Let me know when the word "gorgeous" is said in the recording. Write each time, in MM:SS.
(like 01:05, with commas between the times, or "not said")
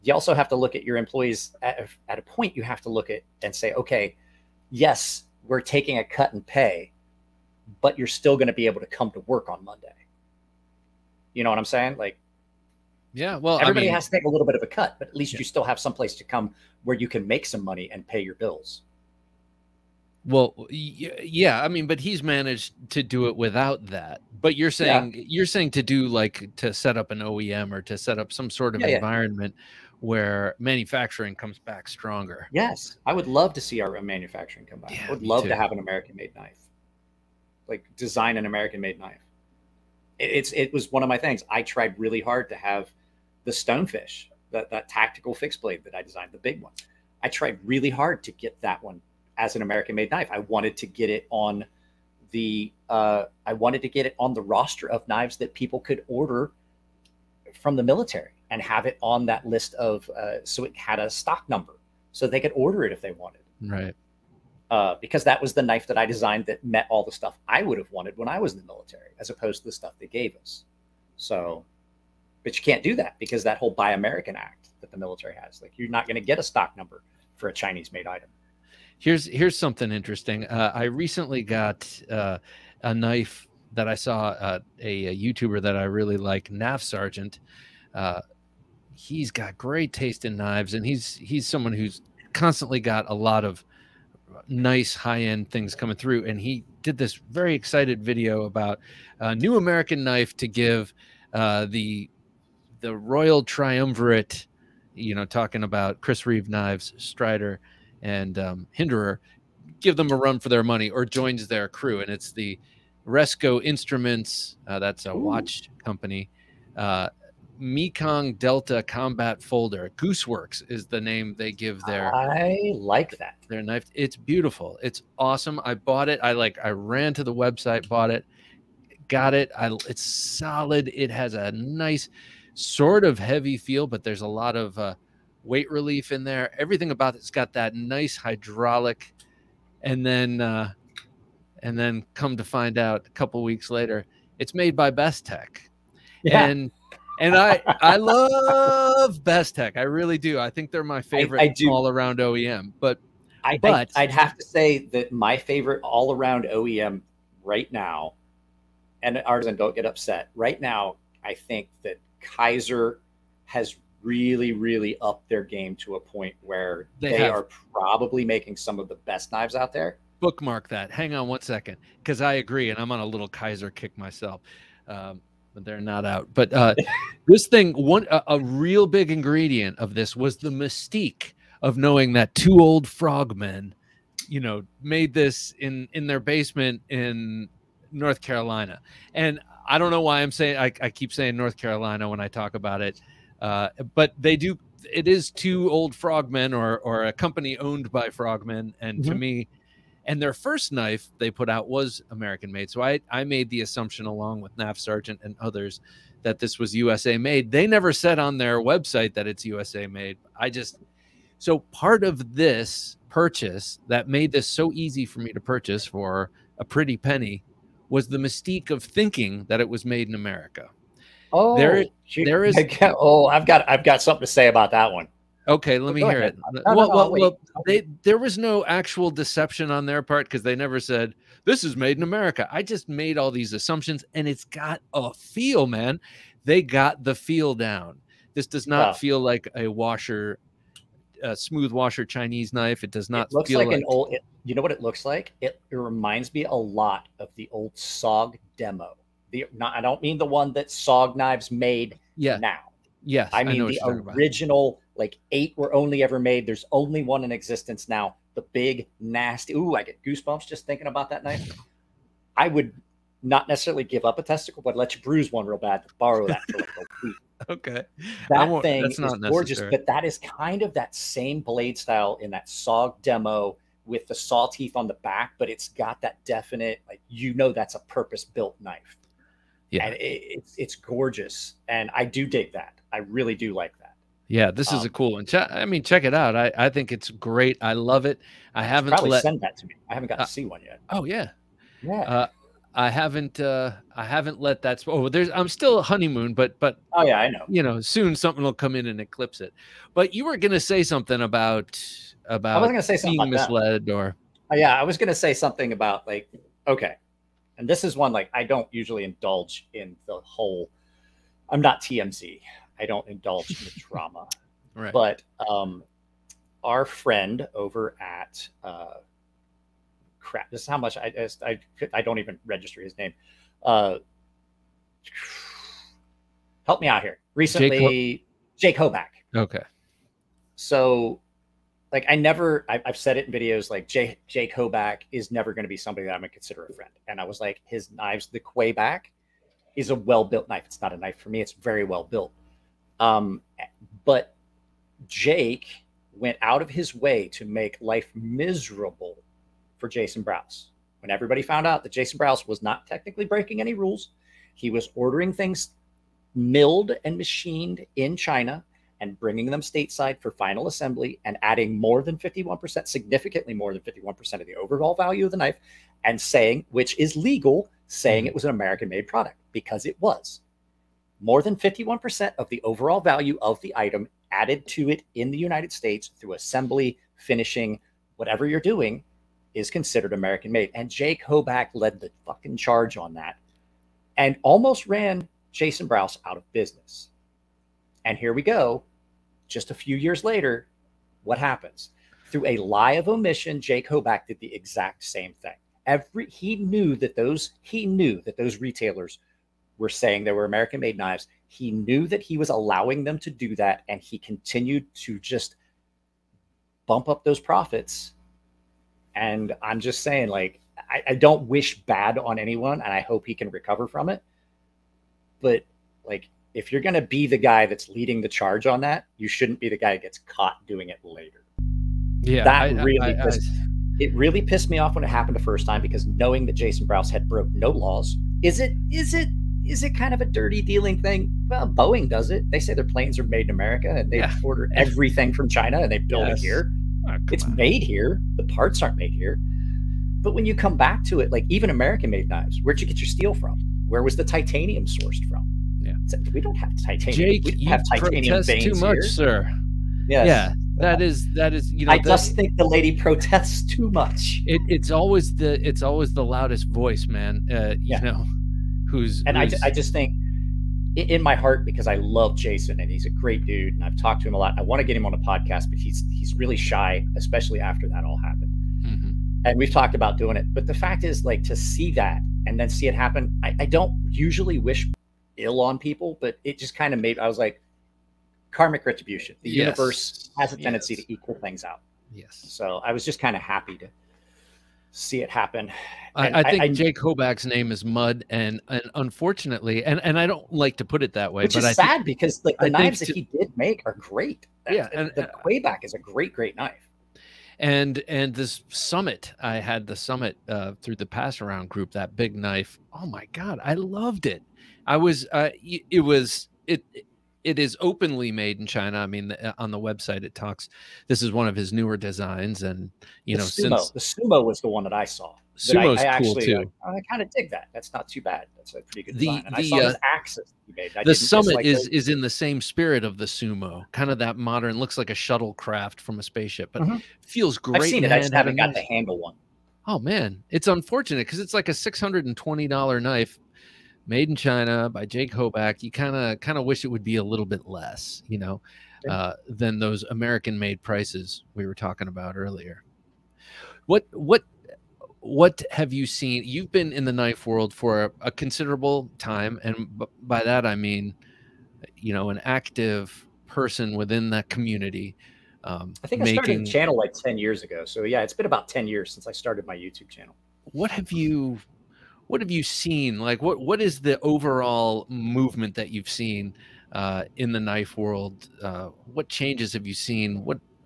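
04:29, 04:40.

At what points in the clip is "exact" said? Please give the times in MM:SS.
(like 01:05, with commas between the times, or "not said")
06:34.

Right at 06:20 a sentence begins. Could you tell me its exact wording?
And Jake Hoback led the fucking charge on that and almost ran Jason Brous out of business.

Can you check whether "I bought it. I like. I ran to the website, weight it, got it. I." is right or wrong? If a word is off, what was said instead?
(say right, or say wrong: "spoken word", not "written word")
wrong: "bought", not "weight".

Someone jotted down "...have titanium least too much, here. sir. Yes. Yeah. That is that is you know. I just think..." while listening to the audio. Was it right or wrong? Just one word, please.
wrong.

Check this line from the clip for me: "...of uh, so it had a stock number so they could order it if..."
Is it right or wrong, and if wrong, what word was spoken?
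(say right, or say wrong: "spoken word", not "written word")
right.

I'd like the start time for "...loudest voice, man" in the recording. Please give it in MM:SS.
07:36.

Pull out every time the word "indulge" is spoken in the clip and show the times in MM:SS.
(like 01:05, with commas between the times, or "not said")
05:09, 05:13.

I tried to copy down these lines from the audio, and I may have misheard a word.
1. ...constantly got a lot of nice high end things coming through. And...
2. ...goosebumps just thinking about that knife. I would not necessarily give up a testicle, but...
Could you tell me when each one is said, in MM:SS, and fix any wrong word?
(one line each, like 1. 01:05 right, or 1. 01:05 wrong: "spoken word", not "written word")
1. 01:32 right
2. 04:20 right.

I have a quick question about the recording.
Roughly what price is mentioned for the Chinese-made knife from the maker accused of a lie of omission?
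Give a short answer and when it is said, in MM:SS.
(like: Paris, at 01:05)
$620, at 08:51.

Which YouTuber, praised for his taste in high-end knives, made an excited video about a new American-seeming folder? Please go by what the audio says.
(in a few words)
Nav Sergeant.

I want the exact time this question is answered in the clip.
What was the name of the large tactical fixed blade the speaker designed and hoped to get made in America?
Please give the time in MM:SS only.
00:43.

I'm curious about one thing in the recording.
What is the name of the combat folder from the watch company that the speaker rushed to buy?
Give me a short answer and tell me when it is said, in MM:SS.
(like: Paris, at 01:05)
Mekong Delta Combat Folder, at 01:57.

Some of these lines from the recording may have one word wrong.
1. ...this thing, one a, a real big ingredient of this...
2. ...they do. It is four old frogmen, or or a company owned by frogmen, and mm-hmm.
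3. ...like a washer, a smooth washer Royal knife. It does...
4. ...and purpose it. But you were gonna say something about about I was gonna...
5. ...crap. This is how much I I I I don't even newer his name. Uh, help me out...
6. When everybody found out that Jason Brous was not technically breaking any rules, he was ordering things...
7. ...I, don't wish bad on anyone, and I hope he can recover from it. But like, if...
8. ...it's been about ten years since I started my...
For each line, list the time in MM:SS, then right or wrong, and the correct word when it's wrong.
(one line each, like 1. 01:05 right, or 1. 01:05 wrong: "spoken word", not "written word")
1. 02:57 right
2. 03:14 wrong: "two", not "four"
3. 03:59 wrong: "Chinese", not "Royal"
4. 04:58 wrong: "eclipse", not "purpose"
5. 05:20 wrong: "register", not "newer"
6. 05:50 right
7. 06:51 right
8. 09:18 right.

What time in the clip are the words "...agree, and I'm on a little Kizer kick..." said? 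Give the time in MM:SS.
02:52.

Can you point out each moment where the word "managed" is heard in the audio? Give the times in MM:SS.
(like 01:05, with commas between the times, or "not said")
00:22.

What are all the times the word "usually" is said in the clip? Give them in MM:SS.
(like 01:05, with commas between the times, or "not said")
05:08, 07:54.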